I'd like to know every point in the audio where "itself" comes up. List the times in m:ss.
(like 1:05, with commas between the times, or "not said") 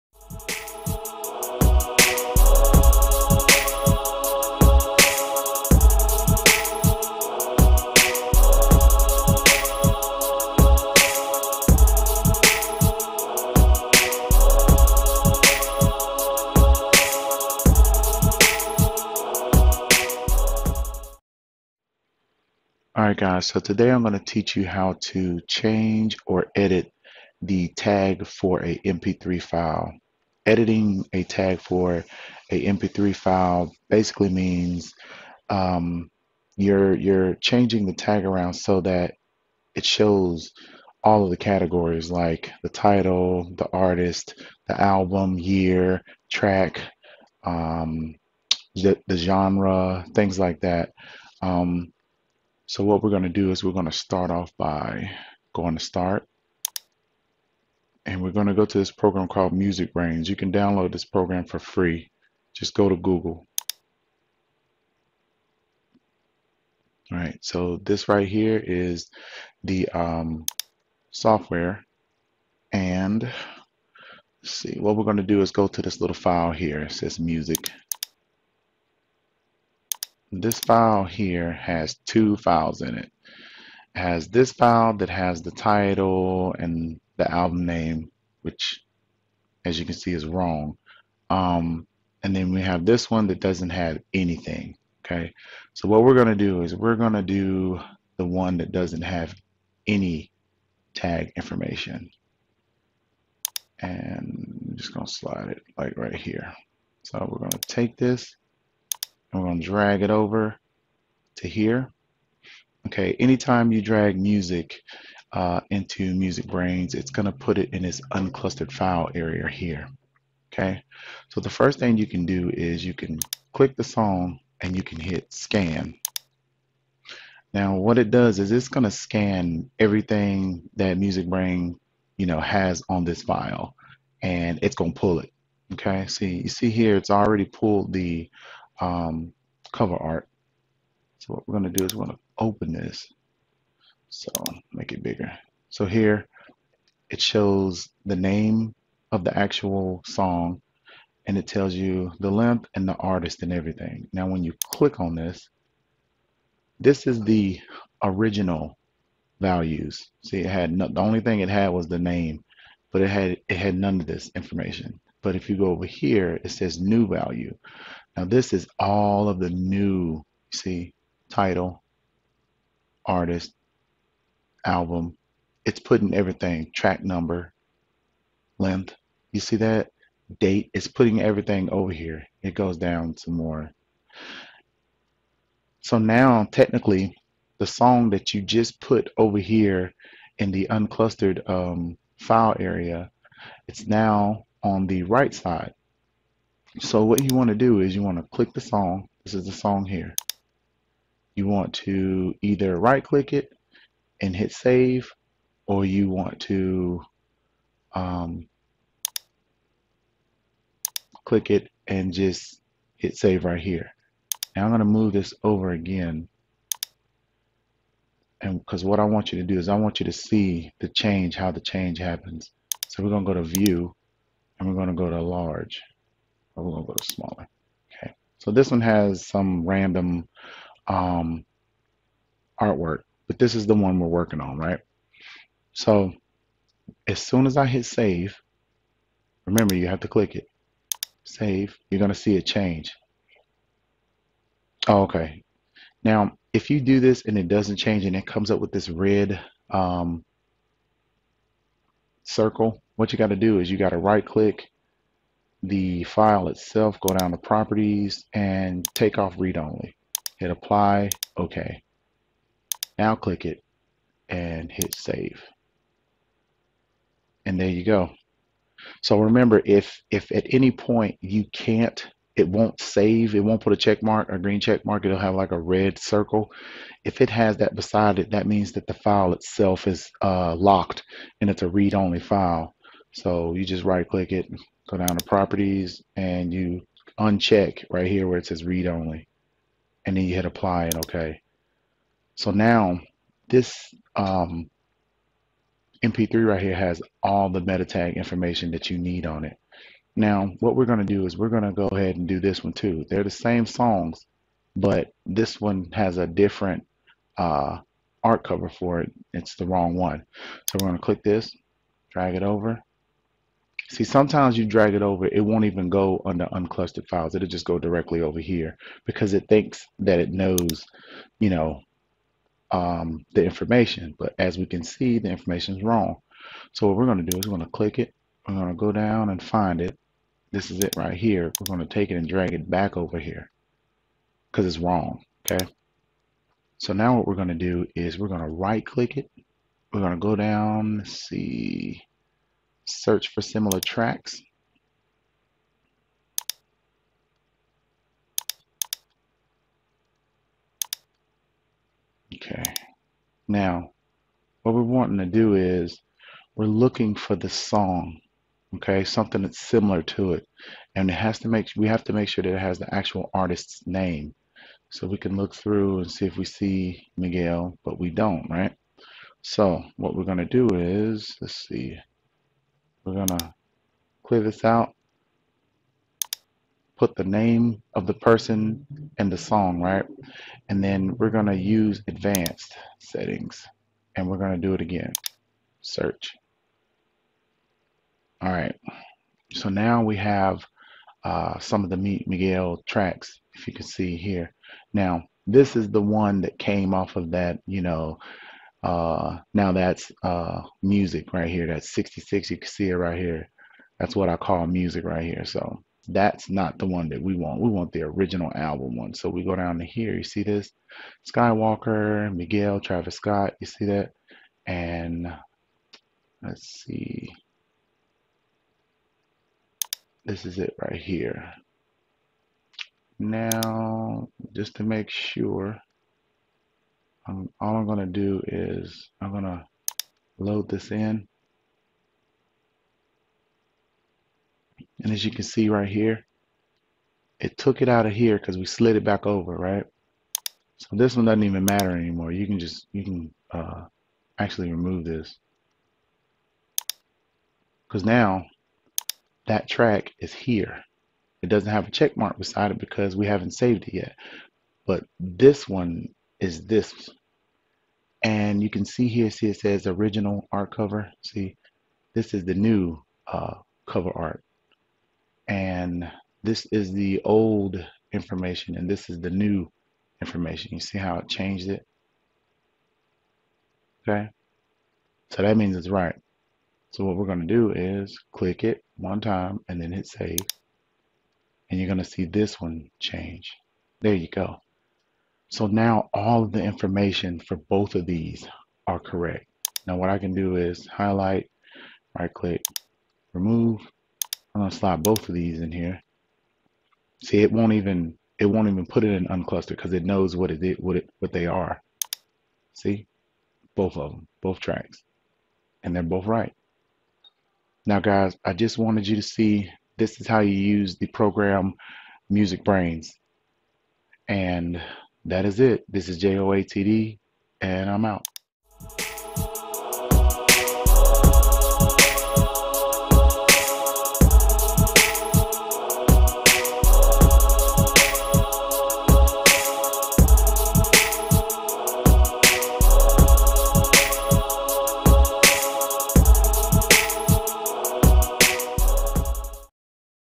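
4:16, 4:39.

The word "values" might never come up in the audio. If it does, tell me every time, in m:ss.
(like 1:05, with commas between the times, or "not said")
2:39, 2:47.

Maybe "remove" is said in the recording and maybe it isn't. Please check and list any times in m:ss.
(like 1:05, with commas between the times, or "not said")
7:24, 8:13.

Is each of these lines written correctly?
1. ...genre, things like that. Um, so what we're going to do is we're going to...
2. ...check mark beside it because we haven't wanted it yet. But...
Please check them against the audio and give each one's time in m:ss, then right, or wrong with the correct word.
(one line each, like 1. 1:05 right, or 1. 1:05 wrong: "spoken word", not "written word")
1. 0:49 right
2. 7:31 wrong: "saved", not "wanted".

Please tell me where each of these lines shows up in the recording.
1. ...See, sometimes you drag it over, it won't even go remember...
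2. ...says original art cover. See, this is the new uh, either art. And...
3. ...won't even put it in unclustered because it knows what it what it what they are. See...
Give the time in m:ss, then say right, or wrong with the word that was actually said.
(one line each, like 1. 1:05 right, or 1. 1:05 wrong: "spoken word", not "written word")
1. 5:13 wrong: "under", not "remember"
2. 7:39 wrong: "cover", not "either"
3. 8:18 right.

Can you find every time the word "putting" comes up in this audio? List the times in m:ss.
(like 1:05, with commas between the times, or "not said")
2:55, 3:00.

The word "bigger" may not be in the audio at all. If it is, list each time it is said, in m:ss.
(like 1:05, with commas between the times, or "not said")
2:25.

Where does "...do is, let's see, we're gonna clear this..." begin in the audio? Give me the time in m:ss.
6:10.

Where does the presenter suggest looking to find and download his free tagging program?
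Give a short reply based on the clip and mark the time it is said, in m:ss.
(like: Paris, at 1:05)
Google, at 1:02.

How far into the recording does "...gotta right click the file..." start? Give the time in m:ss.
4:13.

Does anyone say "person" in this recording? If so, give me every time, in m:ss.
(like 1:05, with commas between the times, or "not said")
6:18.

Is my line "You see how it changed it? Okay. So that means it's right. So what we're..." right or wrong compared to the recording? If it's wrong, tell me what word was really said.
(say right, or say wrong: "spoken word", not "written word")
right.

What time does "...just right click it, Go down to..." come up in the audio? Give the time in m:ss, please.
4:43.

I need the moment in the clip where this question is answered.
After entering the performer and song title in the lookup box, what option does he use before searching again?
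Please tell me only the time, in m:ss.
6:22.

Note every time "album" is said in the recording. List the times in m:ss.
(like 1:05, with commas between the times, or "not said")
0:44, 1:27, 2:54, 6:48.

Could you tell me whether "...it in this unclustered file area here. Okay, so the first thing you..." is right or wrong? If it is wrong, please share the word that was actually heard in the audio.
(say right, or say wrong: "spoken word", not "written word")
right.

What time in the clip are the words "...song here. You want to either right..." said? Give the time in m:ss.
3:19.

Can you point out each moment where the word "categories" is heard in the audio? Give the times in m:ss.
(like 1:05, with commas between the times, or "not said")
0:41.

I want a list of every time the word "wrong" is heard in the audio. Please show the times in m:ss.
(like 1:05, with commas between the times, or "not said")
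1:30, 5:09, 5:25, 5:34.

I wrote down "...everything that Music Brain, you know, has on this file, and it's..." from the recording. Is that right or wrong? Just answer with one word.
right.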